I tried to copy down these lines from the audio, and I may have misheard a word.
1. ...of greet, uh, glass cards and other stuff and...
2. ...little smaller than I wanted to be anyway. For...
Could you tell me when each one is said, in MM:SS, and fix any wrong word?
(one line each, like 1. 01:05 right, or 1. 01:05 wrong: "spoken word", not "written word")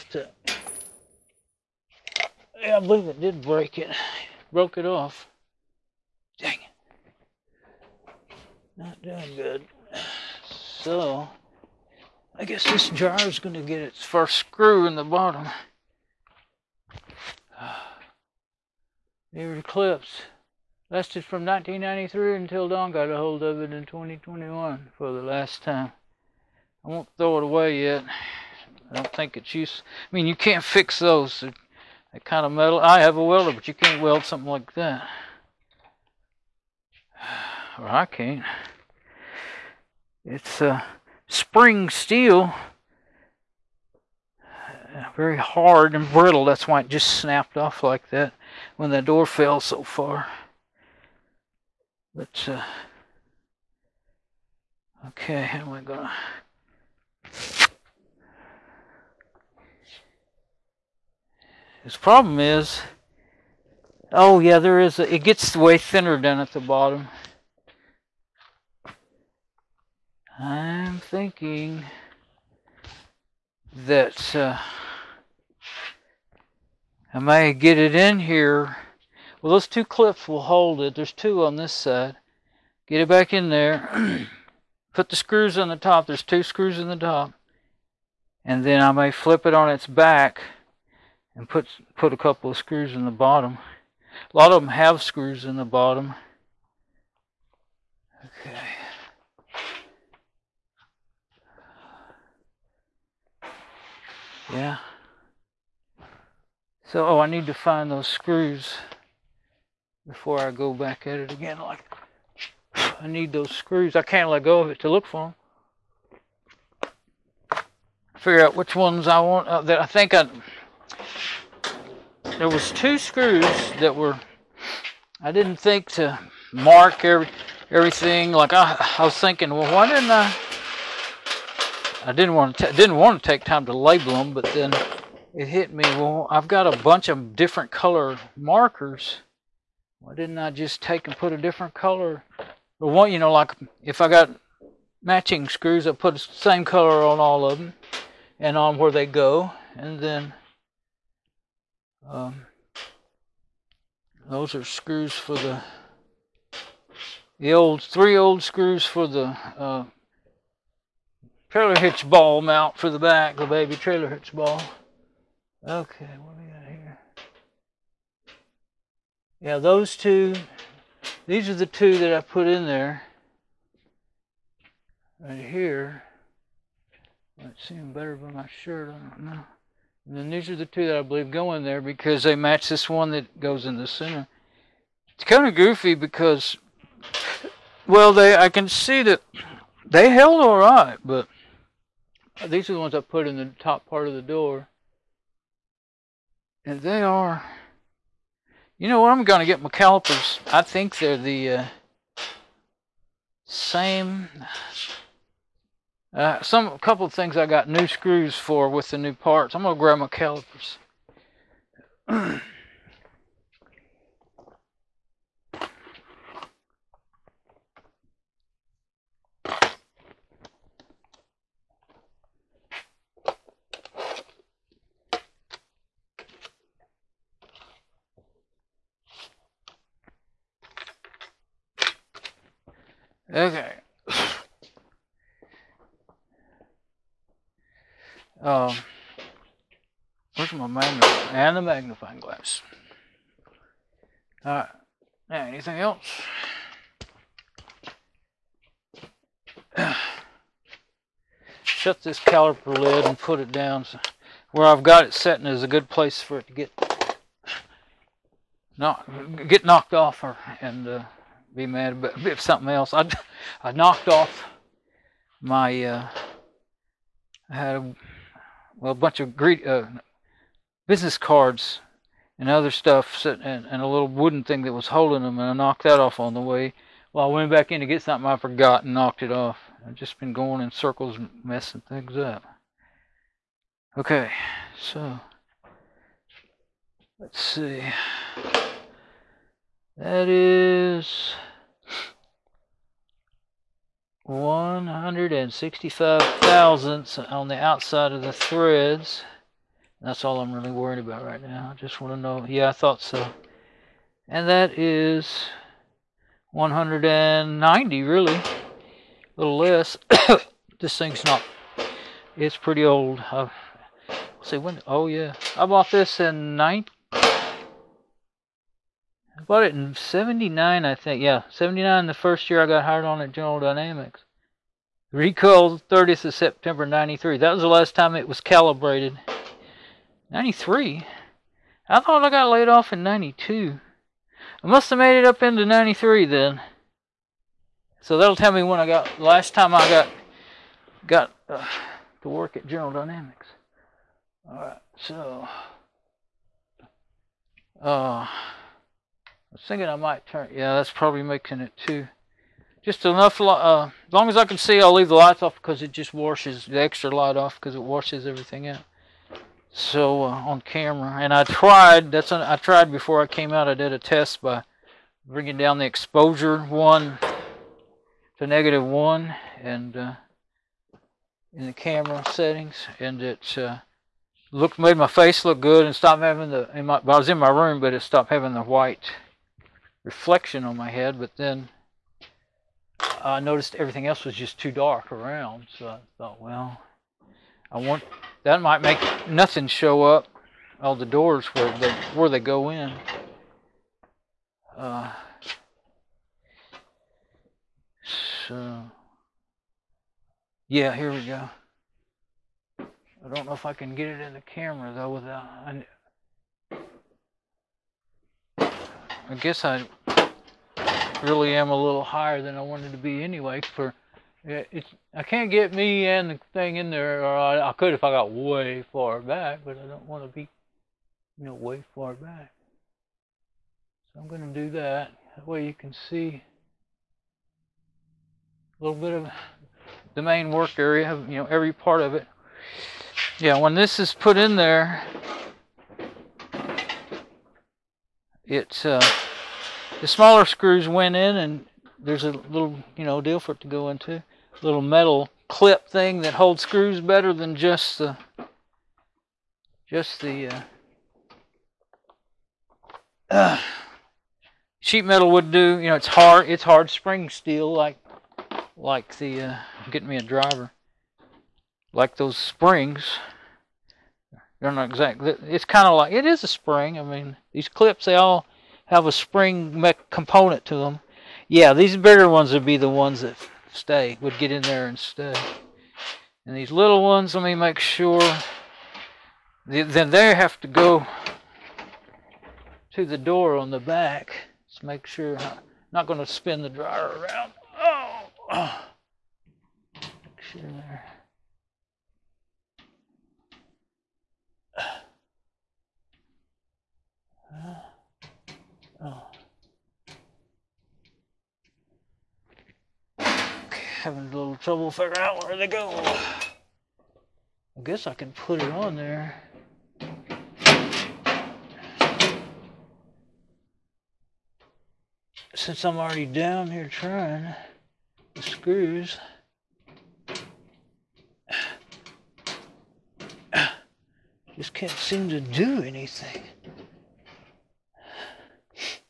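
1. 04:29 wrong: "business", not "glass"
2. 06:51 wrong: "higher", not "smaller".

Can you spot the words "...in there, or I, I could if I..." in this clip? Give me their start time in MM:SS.
06:56.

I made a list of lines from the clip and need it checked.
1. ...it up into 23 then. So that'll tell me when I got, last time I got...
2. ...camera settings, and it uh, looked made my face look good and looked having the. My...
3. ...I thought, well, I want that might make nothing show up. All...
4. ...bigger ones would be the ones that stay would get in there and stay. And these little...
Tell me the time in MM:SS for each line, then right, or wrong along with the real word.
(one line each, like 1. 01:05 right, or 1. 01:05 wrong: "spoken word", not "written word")
1. 05:35 wrong: "93", not "23"
2. 06:11 wrong: "stopped", not "looked"
3. 06:25 right
4. 07:51 right.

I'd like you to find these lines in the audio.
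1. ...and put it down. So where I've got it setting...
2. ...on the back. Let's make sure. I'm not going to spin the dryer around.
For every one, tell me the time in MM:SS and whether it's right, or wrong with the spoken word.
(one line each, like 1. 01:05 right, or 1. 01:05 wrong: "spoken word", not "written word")
1. 04:13 right
2. 08:03 right.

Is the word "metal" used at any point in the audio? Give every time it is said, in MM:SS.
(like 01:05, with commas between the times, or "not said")
00:32, 07:24, 07:35.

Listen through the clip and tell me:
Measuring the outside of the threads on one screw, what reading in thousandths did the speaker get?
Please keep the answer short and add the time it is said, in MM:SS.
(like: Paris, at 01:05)
165 thousandths, at 04:54.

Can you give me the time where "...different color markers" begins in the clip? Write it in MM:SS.
02:17.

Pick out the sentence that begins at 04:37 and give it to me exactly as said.
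Well, I went back in to get something I forgot and knocked it off.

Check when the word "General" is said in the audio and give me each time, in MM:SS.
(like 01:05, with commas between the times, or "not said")
05:23, 05:42.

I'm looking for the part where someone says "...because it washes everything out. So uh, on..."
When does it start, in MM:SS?
05:57.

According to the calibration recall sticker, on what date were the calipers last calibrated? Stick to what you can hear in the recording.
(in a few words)
30 September 1993.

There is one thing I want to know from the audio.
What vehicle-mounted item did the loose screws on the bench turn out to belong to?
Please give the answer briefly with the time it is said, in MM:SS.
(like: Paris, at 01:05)
Trailer hitch ball mount, at 02:41.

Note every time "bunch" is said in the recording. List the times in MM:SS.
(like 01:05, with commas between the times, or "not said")
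02:16, 04:28.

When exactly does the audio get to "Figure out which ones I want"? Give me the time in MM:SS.
01:58.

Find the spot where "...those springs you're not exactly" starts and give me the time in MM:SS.
07:42.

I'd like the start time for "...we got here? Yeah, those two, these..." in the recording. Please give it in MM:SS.
02:46.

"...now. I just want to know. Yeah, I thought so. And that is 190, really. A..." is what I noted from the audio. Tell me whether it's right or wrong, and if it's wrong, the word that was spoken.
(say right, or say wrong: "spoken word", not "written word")
right.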